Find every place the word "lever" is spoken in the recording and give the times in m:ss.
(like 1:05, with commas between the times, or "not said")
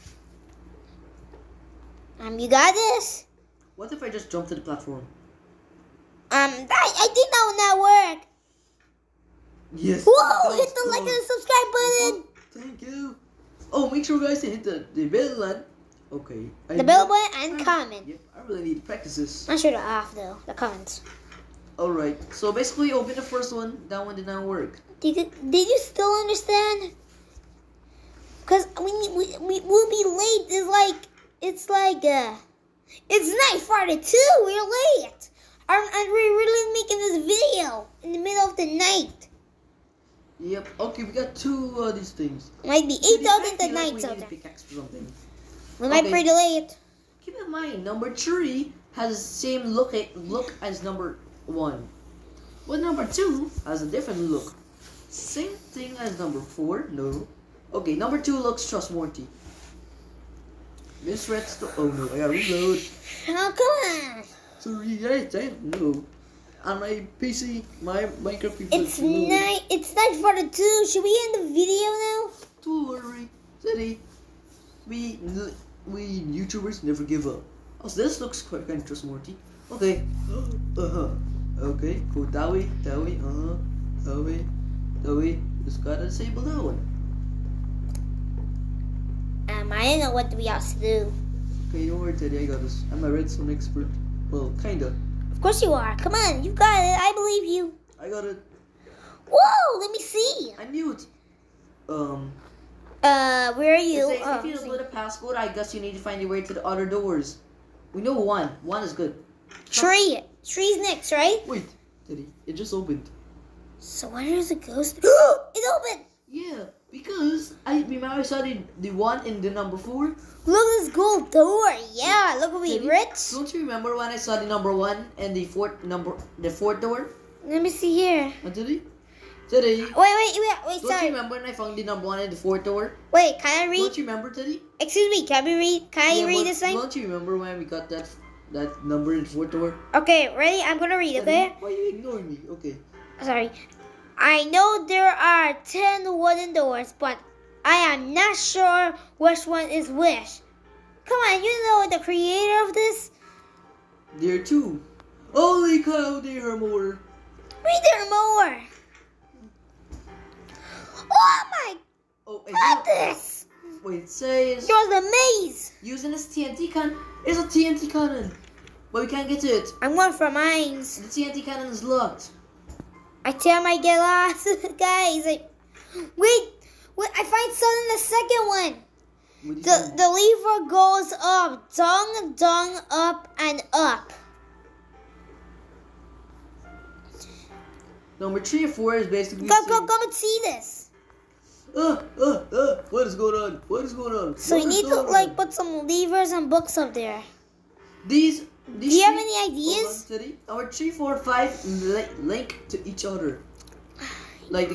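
3:00, 3:15.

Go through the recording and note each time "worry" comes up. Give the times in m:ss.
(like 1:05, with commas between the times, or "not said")
1:12, 1:31.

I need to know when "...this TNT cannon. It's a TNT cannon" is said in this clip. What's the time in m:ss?
2:46.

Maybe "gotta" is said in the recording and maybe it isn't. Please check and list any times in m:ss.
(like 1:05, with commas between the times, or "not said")
1:02, 1:25.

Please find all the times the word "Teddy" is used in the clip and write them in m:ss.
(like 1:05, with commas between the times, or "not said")
1:13, 1:32, 2:09, 2:14, 2:21.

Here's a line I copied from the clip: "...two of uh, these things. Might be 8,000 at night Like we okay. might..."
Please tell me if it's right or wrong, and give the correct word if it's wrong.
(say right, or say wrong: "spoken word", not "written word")
right.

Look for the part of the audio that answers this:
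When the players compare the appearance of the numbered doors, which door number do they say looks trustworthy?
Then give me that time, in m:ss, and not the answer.
0:57.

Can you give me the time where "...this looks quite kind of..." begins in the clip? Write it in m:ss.
1:18.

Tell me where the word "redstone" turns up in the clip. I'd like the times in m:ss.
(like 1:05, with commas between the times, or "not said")
1:01, 1:33.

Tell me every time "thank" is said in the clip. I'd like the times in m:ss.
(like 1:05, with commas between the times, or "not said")
0:12.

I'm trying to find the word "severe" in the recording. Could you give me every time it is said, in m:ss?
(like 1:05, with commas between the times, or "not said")
not said.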